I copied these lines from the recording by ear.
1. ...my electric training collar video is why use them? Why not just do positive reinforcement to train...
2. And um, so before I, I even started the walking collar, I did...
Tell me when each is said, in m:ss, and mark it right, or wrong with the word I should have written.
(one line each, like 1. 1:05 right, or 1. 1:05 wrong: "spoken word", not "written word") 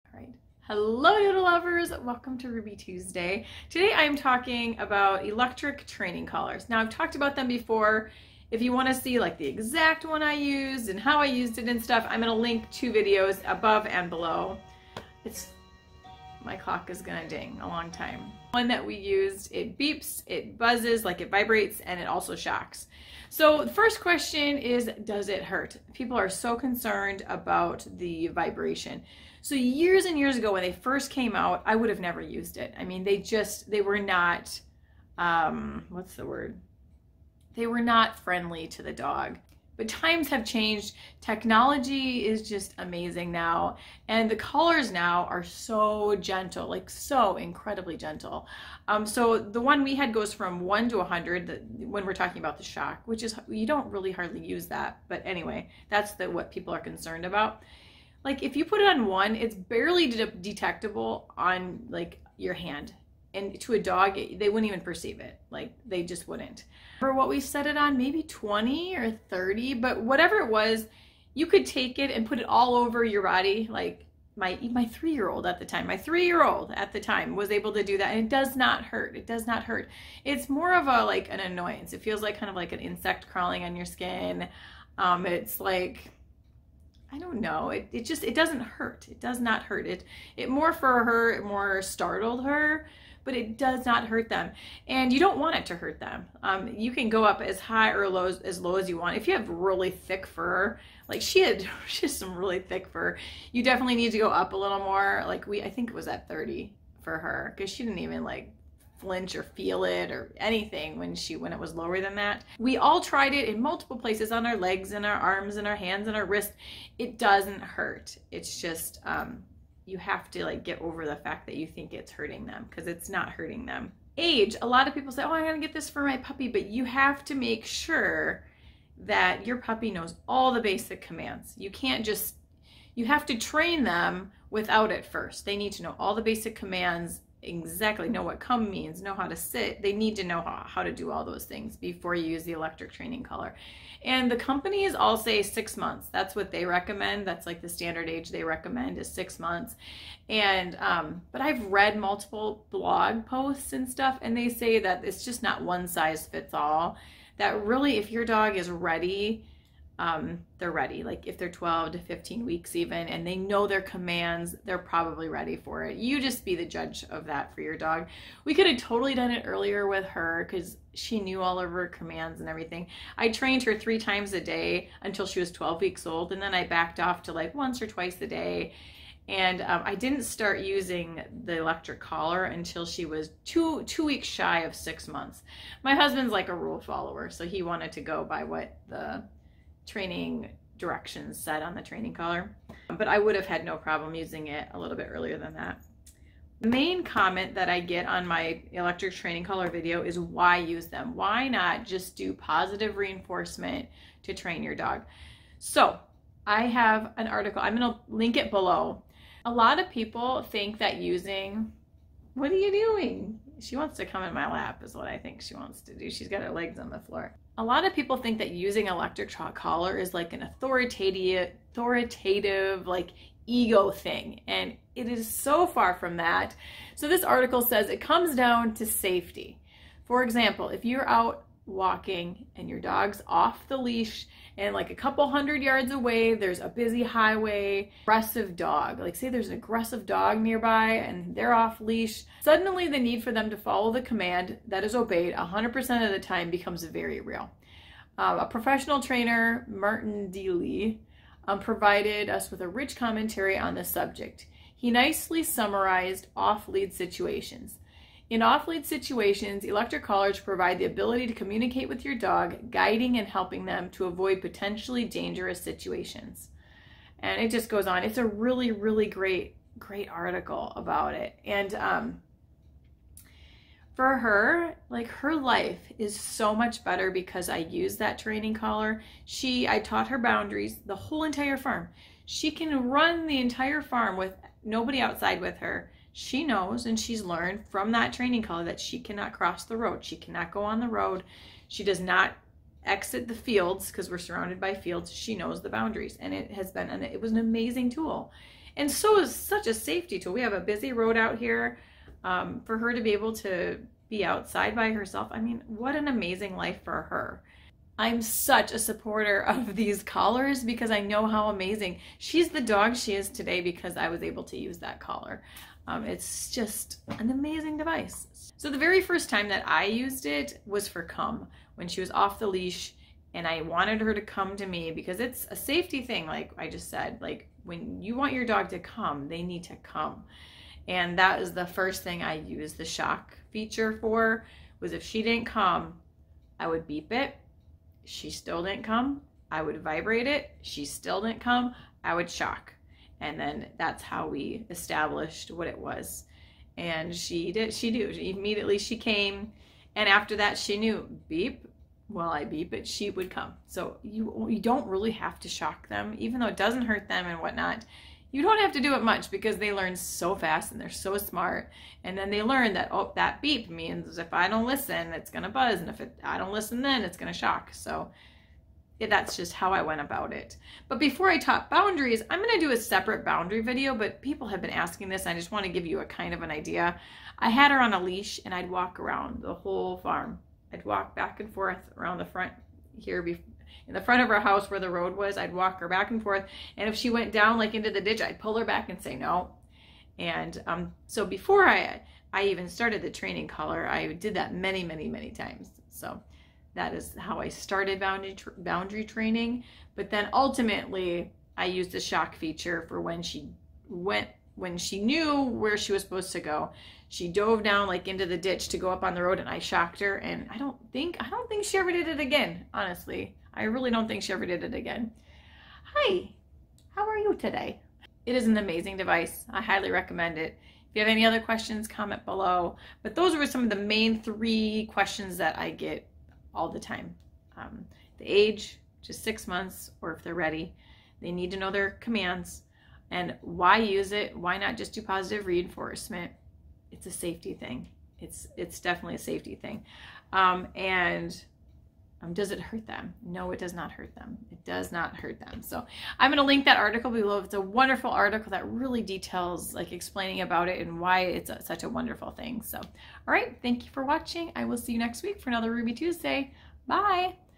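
1. 3:18 right
2. 6:30 wrong: "training", not "walking".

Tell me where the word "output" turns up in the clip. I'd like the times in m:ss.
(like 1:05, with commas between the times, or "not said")
not said.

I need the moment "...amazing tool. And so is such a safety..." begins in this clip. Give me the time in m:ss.
4:57.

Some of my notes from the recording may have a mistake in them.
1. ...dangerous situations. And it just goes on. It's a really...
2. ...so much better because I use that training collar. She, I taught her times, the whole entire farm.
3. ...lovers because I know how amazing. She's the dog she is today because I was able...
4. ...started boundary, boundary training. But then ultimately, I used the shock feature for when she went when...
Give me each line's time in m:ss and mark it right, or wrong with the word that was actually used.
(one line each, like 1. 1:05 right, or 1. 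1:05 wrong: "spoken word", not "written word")
1. 4:25 right
2. 4:36 wrong: "boundaries", not "times"
3. 5:10 wrong: "collars", not "lovers"
4. 6:37 right.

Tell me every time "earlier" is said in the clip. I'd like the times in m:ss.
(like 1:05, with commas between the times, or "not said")
2:49, 3:15.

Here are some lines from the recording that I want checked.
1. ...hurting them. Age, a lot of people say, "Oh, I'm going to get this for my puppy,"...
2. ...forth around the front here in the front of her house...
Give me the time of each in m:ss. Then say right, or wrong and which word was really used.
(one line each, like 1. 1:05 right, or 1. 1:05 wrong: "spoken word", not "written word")
1. 2:03 right
2. 6:21 right.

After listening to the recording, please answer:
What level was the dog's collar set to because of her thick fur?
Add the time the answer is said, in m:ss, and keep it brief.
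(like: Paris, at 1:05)
30, at 1:45.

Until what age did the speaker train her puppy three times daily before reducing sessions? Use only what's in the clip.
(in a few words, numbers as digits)
12 weeks.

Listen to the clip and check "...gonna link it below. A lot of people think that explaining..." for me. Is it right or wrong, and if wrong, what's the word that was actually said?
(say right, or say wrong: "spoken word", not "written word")
wrong: "using", not "explaining".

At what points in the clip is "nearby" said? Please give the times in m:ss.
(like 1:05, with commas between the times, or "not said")
4:00.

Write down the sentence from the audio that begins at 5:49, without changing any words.
And after that, she knew beep.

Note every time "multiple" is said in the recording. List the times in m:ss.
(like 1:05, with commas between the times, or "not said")
1:53, 2:31.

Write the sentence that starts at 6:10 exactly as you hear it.
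But before I taught boundaries, I'm going to do a separate boundary video, but people have been asking this.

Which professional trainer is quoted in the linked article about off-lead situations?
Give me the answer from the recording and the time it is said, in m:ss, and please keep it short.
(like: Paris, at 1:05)
Martin Deeley, at 4:09.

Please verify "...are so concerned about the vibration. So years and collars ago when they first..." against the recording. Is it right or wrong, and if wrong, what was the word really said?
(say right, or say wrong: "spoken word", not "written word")
wrong: "years", not "collars".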